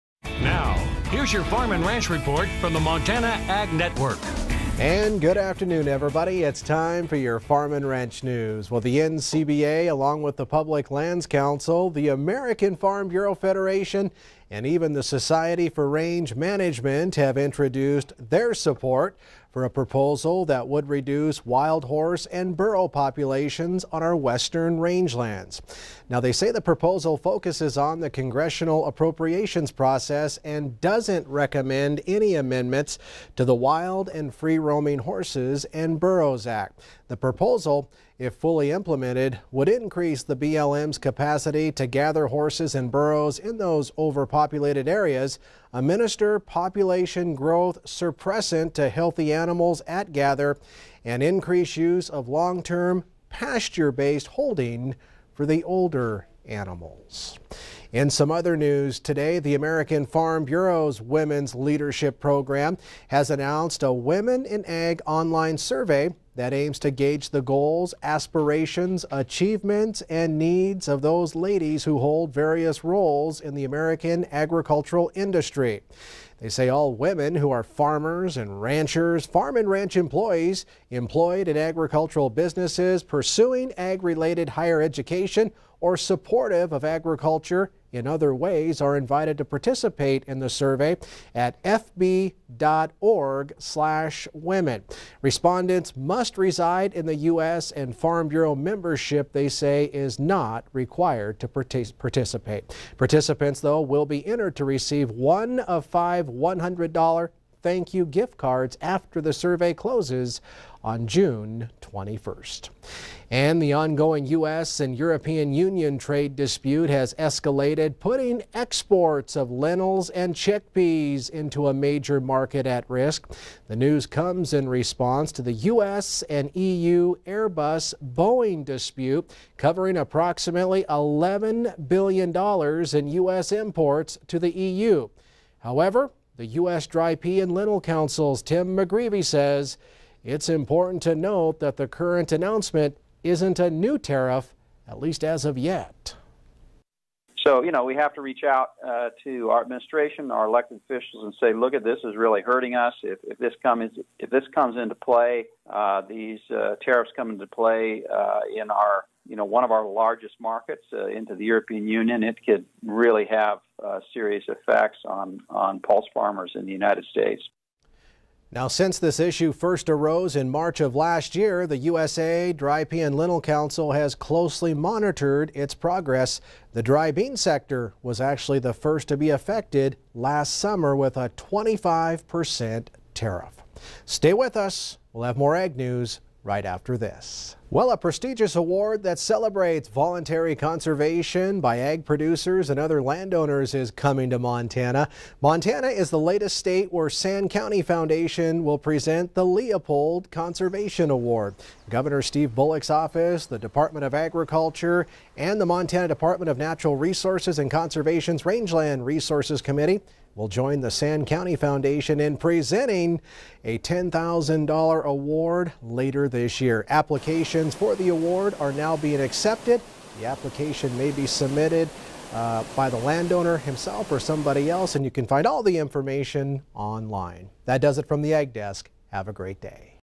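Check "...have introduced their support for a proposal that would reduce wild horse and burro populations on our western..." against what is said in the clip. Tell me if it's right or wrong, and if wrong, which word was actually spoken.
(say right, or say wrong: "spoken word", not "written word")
right.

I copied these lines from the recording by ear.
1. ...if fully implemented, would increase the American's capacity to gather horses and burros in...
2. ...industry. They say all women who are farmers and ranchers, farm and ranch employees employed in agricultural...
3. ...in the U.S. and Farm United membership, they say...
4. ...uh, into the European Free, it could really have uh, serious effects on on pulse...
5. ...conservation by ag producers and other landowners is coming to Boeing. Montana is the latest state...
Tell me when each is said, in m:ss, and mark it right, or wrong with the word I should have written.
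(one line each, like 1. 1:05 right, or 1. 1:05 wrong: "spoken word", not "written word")
1. 0:38 wrong: "BLM", not "American"
2. 1:15 right
3. 1:36 wrong: "Bureau", not "United"
4. 2:40 wrong: "Union", not "Free"
5. 3:10 wrong: "Montana", not "Boeing".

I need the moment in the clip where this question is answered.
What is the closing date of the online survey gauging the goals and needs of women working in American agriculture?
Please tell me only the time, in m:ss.
1:51.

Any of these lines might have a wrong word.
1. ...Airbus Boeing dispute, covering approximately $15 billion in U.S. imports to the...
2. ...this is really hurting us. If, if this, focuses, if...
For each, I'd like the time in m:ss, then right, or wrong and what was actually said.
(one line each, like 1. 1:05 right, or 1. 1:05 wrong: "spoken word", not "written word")
1. 2:07 wrong: "11", not "15"
2. 2:31 wrong: "comes", not "focuses".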